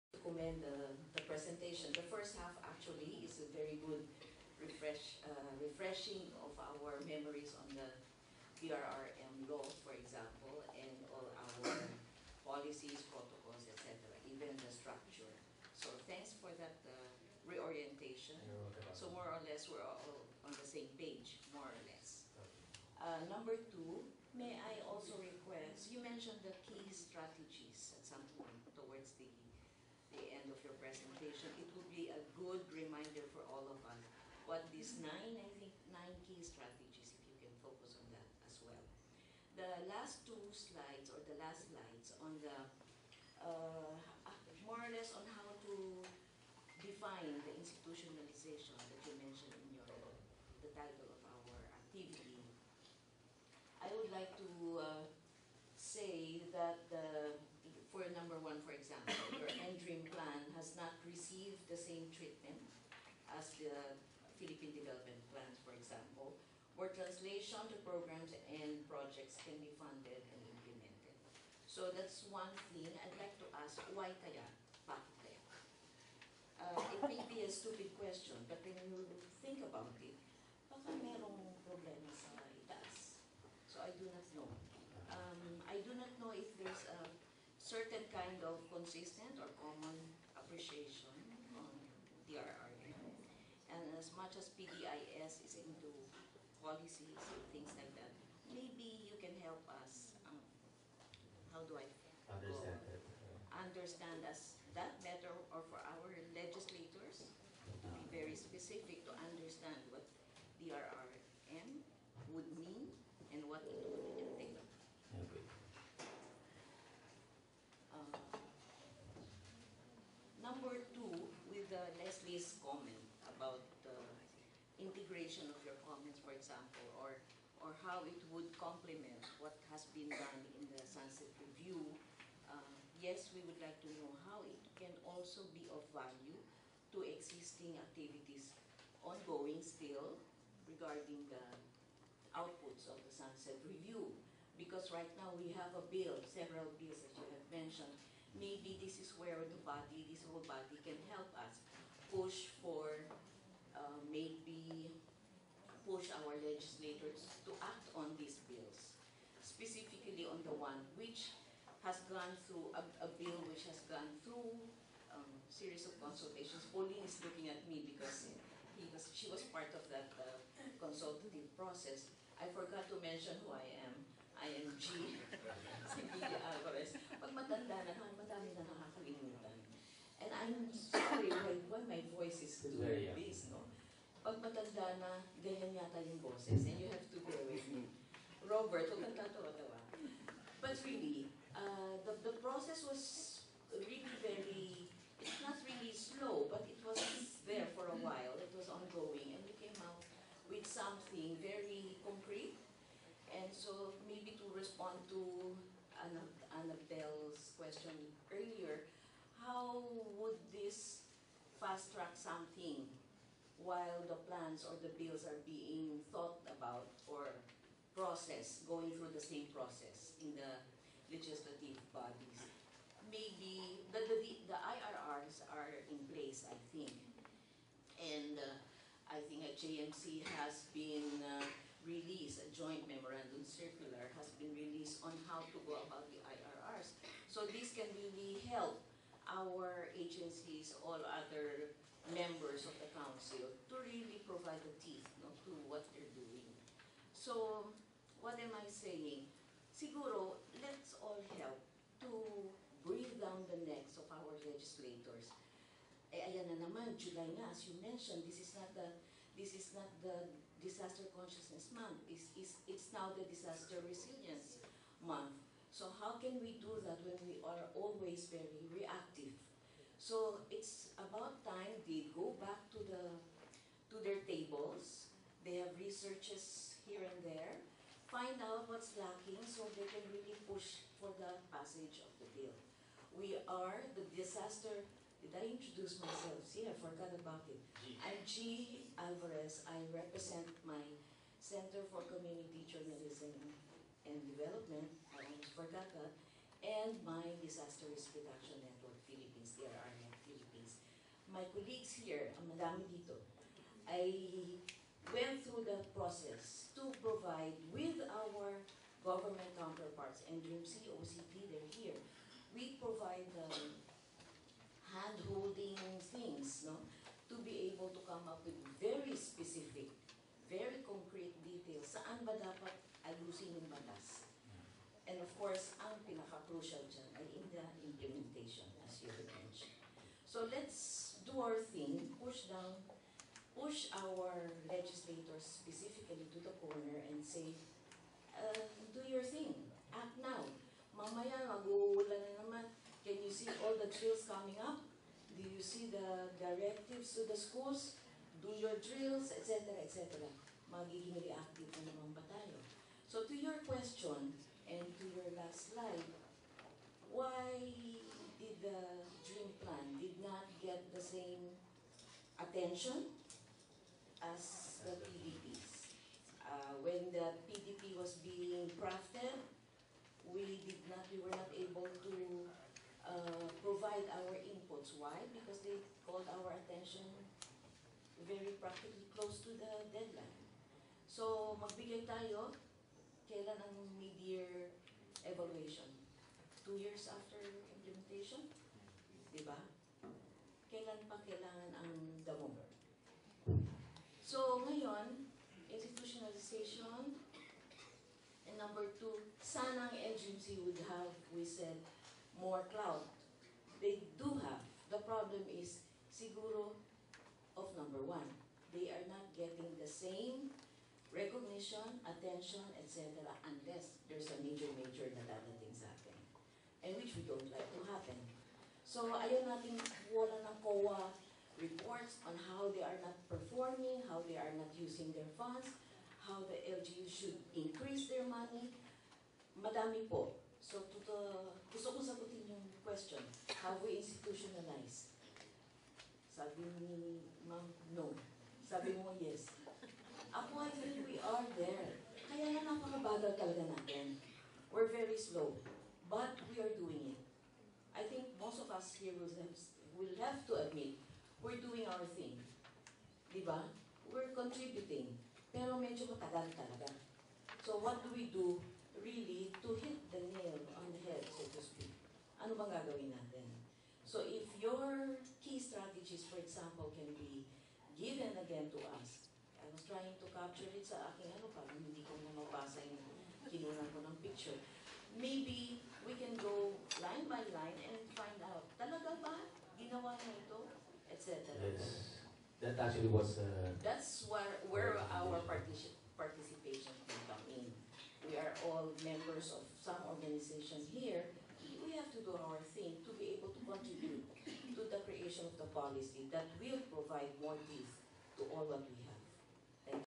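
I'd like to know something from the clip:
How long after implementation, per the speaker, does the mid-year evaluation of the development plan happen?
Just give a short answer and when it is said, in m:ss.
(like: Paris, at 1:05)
2 years, at 6:26.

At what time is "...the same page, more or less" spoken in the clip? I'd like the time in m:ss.
0:20.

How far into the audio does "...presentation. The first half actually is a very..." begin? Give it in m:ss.
0:01.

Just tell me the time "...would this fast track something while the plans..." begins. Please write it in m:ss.
3:30.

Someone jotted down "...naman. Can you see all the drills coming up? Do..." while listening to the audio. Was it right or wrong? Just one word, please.
right.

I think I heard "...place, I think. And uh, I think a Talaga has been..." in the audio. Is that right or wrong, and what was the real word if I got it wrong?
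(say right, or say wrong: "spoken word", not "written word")
wrong: "JMC", not "Talaga".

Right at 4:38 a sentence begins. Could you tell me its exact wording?
Find out what's lacking so they can really push for the passage of the bill.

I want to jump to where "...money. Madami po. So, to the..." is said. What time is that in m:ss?
7:08.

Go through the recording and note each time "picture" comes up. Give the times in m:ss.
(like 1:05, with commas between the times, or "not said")
7:54.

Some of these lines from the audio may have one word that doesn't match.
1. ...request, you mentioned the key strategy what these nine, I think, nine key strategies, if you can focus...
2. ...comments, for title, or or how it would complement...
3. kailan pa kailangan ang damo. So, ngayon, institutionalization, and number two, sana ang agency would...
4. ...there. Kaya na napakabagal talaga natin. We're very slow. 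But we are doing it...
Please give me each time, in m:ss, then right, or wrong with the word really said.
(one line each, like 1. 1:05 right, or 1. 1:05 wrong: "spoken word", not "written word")
1. 0:25 right
2. 2:05 wrong: "example", not "title"
3. 6:30 right
4. 7:21 right.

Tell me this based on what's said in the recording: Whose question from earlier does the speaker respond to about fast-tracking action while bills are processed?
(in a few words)
Annabelle.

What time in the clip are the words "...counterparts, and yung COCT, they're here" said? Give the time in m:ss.
5:09.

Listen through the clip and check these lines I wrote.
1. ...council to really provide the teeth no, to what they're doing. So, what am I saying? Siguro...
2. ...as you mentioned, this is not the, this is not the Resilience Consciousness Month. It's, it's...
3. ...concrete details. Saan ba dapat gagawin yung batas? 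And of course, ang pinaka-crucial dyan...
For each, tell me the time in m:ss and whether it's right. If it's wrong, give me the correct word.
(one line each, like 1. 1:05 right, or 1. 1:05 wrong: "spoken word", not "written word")
1. 4:02 right
2. 4:17 wrong: "Disaster", not "Resilience"
3. 5:20 wrong: "ayusin", not "gagawin".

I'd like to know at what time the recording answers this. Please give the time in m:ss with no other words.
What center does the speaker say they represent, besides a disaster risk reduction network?
4:51.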